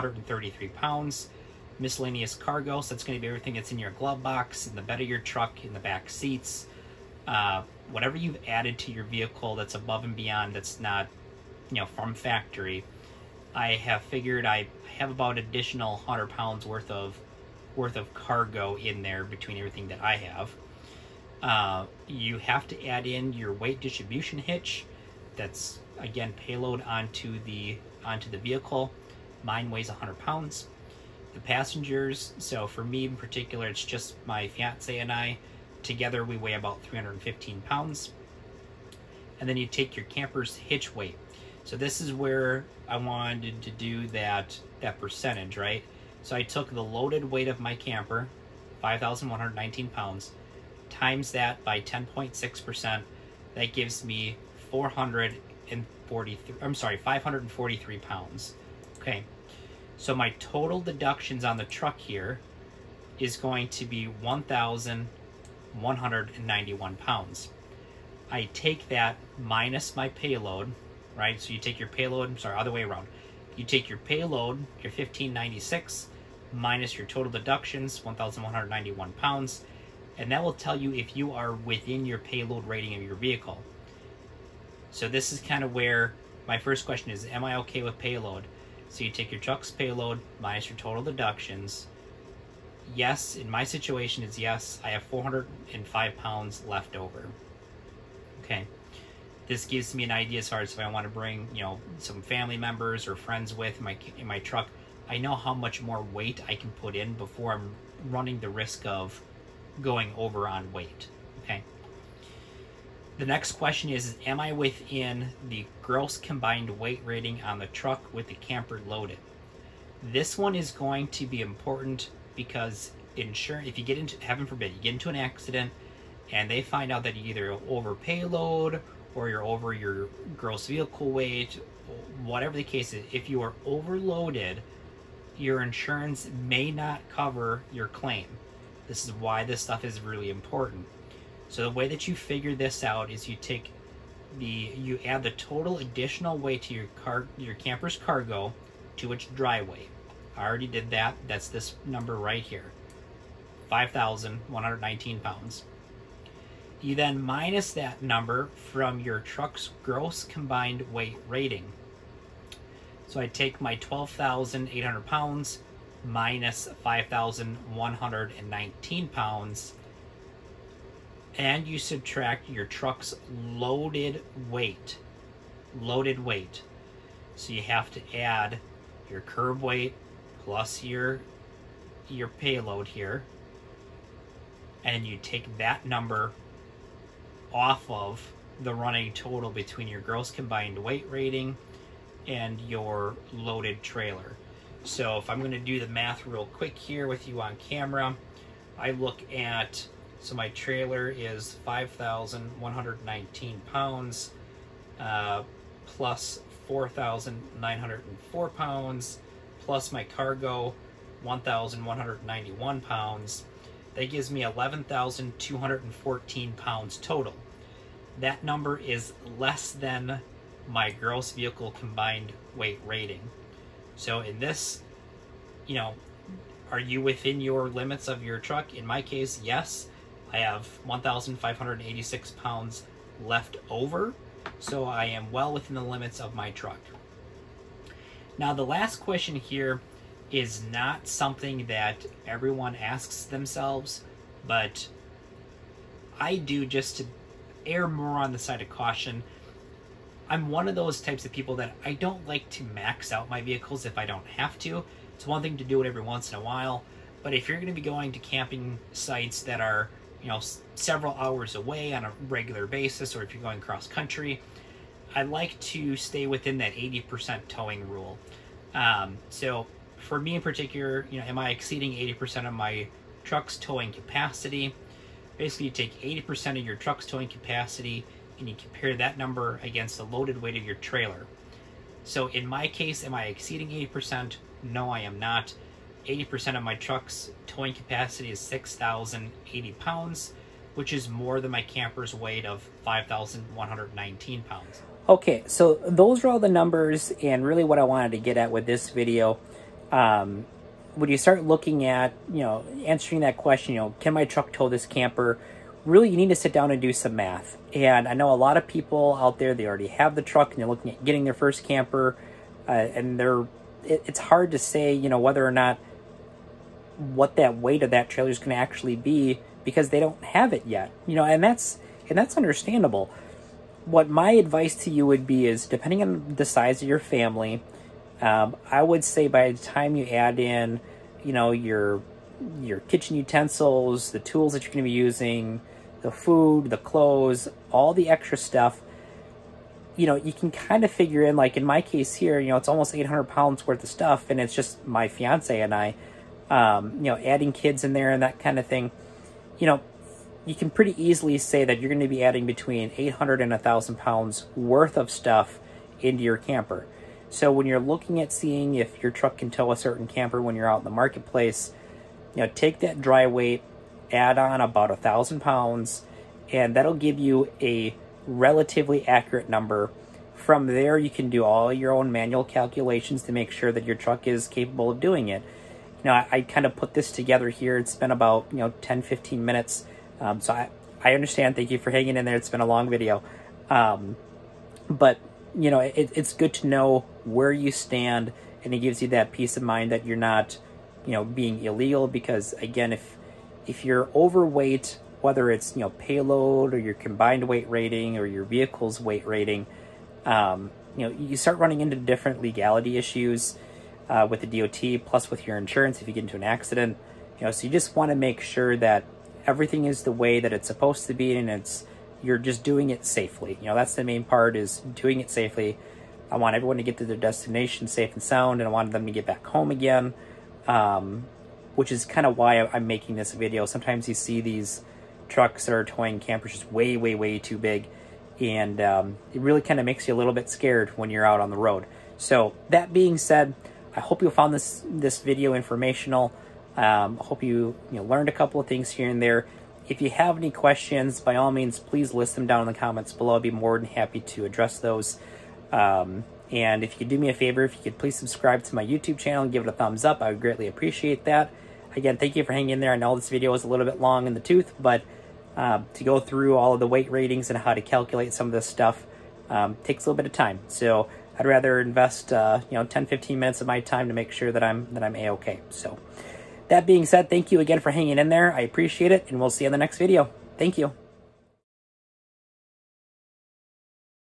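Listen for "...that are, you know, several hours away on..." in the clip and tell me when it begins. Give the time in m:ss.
4:19.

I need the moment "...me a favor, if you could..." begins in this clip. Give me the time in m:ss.
7:27.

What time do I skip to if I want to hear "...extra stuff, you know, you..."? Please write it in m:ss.
5:38.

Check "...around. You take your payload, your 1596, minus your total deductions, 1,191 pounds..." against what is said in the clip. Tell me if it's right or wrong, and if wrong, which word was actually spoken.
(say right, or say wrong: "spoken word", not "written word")
right.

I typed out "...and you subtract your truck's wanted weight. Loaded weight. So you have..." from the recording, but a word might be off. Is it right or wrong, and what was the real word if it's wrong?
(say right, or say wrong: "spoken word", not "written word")
wrong: "loaded", not "wanted".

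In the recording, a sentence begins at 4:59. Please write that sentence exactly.
Um, when you start looking at, you know, answering that question, you know, can my truck tow this camper?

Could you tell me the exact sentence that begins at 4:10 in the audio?
I'm one of those types of people that I don't like to max out my vehicles if I don't have to.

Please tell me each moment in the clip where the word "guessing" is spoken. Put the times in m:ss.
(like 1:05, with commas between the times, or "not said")
not said.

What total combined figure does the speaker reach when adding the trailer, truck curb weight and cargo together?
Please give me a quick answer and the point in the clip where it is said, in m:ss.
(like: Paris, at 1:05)
11,214 pounds, at 3:34.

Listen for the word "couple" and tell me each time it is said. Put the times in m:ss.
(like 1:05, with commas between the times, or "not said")
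7:18.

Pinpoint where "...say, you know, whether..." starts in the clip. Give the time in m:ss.
5:14.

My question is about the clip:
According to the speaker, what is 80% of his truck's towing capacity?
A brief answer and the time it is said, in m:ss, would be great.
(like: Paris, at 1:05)
6,080 pounds, at 4:48.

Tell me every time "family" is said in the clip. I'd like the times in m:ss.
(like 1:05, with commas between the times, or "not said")
1:42, 5:26.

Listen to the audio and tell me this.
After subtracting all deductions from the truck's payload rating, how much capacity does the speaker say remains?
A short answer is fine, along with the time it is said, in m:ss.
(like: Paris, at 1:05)
405 pounds, at 1:35.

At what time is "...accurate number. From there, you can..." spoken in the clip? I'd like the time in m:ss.
6:09.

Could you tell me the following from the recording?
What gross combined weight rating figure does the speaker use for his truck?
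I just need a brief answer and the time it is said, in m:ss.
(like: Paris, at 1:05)
12,800 pounds, at 2:43.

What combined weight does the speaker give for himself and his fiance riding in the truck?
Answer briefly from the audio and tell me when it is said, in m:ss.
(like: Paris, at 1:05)
315 pounds, at 0:36.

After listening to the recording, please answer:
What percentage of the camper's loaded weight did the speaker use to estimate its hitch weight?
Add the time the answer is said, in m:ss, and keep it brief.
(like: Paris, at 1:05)
10.6%, at 0:51.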